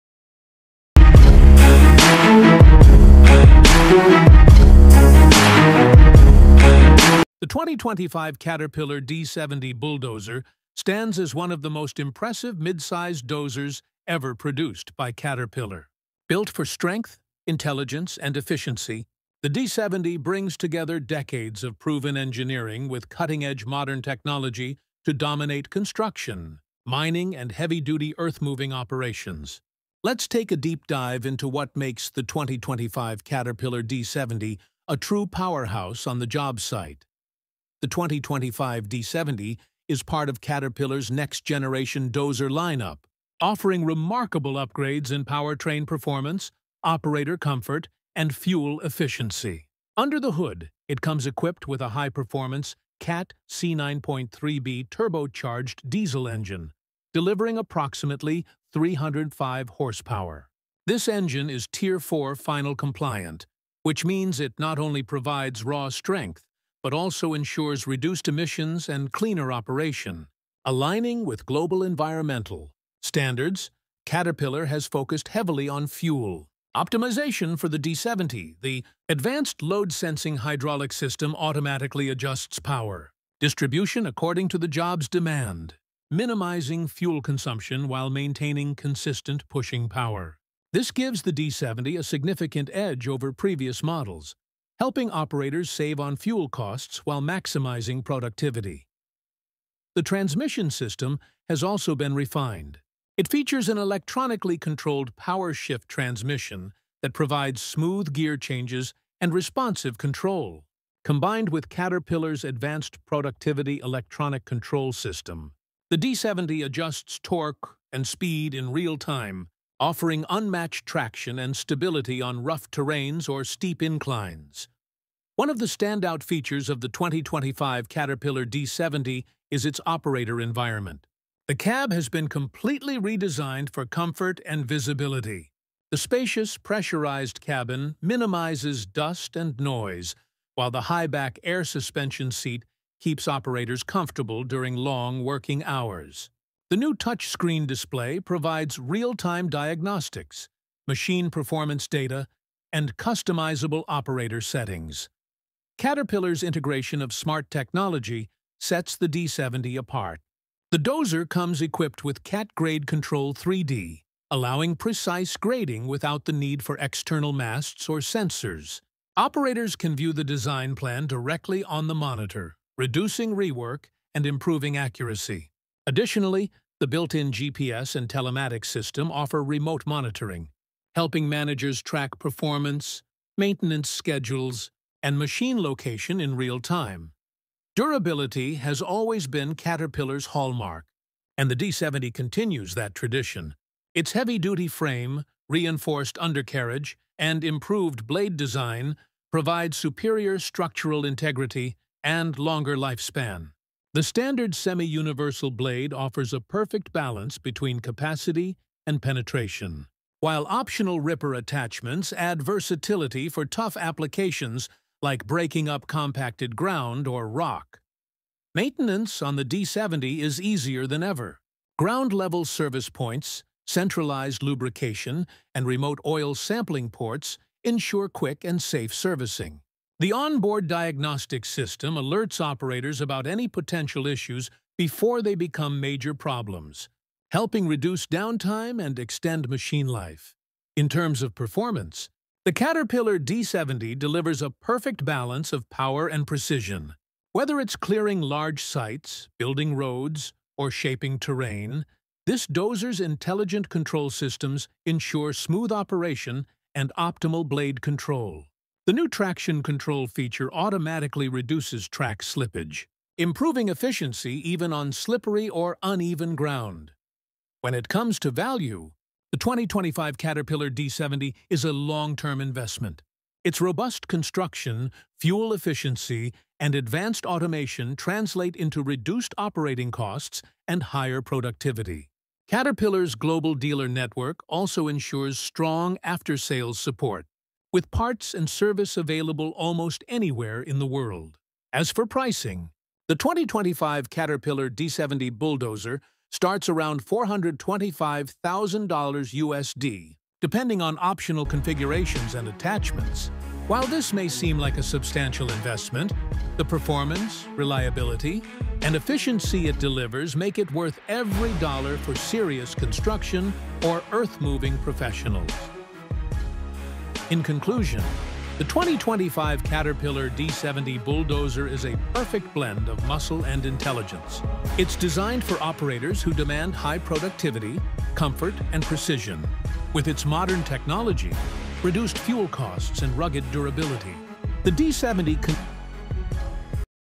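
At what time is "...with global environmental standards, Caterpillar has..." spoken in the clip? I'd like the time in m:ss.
1:11.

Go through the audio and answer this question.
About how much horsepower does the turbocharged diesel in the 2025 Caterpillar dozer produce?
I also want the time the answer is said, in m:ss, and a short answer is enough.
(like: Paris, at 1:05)
305, at 0:58.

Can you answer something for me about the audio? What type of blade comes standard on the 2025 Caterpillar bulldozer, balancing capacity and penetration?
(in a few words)
semi-universal blade.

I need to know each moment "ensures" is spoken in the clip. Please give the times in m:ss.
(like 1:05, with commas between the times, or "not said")
1:07, 3:47, 4:14, 4:44.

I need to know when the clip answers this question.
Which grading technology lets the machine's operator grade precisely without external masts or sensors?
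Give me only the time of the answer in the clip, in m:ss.
2:42.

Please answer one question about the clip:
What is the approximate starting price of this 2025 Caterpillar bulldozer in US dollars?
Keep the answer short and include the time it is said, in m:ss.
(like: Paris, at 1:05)
$425,000, at 4:57.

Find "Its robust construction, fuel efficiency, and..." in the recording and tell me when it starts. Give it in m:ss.
4:33.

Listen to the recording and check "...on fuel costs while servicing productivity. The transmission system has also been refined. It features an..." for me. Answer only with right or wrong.
wrong.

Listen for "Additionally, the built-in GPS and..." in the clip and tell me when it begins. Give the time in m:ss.
2:55.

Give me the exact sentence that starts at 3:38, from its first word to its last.
Maintenance on the D70 is easier than ever.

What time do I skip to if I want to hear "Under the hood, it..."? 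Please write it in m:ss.
0:49.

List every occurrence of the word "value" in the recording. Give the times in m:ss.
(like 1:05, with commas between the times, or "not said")
4:28.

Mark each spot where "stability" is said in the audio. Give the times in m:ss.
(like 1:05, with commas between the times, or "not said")
2:01.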